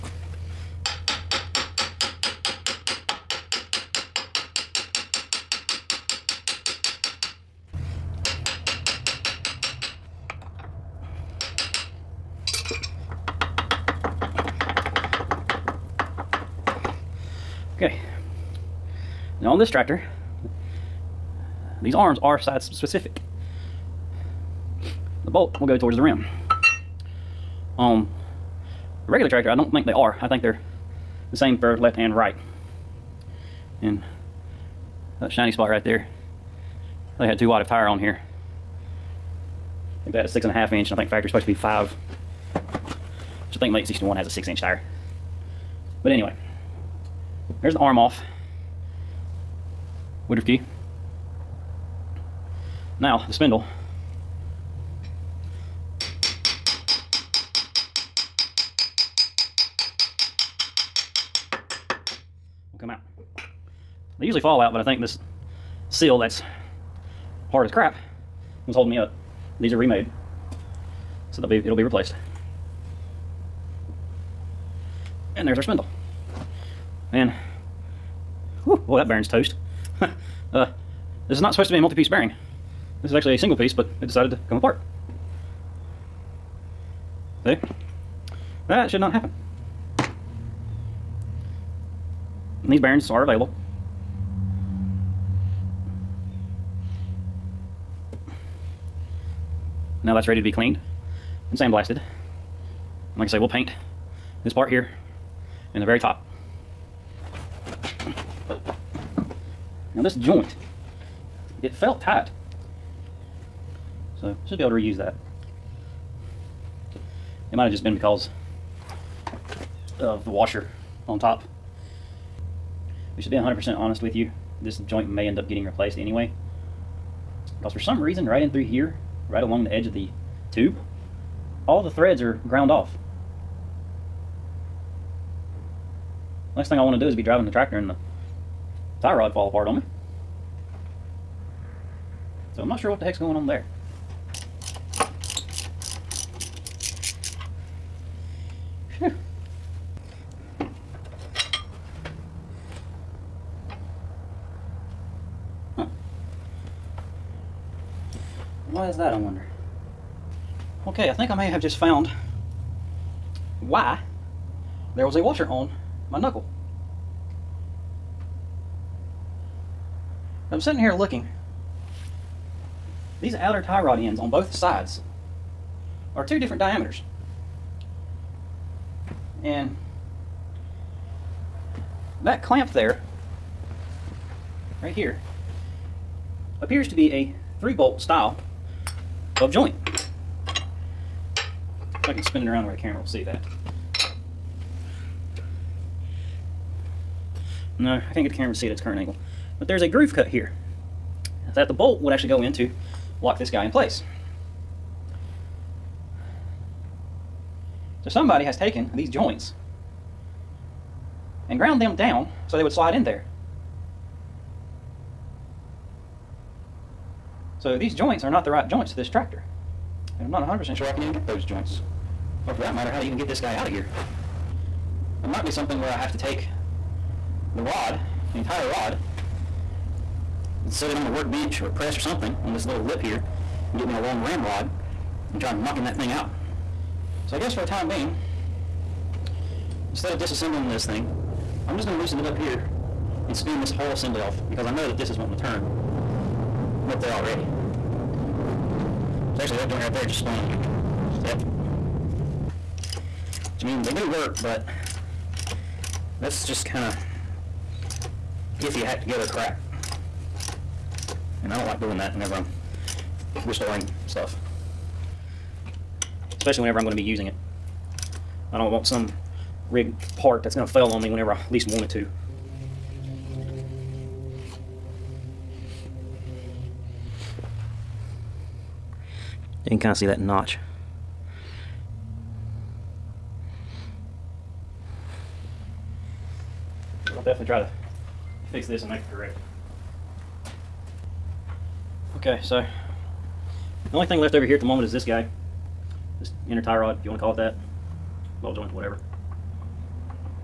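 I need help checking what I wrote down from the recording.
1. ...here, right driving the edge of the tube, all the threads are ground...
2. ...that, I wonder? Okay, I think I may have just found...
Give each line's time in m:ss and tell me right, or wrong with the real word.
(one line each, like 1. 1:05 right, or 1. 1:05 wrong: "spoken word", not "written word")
1. 2:08 wrong: "along", not "driving"
2. 2:38 right.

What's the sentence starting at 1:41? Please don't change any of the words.
And like I say, we'll paint this part here and the very top.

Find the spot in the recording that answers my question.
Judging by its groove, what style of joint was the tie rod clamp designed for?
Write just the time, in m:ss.
3:07.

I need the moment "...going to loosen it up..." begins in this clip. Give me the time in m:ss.
4:01.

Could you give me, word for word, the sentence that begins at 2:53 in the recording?
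These outer tie rod ends on both sides are two different diameters.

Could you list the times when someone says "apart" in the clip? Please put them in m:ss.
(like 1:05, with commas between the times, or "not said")
1:24, 2:19.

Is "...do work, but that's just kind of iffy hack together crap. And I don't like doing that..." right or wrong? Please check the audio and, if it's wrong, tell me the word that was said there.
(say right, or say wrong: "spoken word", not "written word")
right.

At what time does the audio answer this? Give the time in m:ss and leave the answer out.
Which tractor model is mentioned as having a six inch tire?
0:43.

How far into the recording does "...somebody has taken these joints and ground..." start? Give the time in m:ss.
3:28.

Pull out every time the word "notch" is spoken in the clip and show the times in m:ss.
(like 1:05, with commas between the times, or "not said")
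4:40.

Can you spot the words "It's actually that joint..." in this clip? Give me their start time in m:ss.
4:09.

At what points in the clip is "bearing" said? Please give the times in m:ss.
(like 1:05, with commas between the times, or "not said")
1:22, 1:32.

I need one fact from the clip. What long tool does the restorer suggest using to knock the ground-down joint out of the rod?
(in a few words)
ramrod.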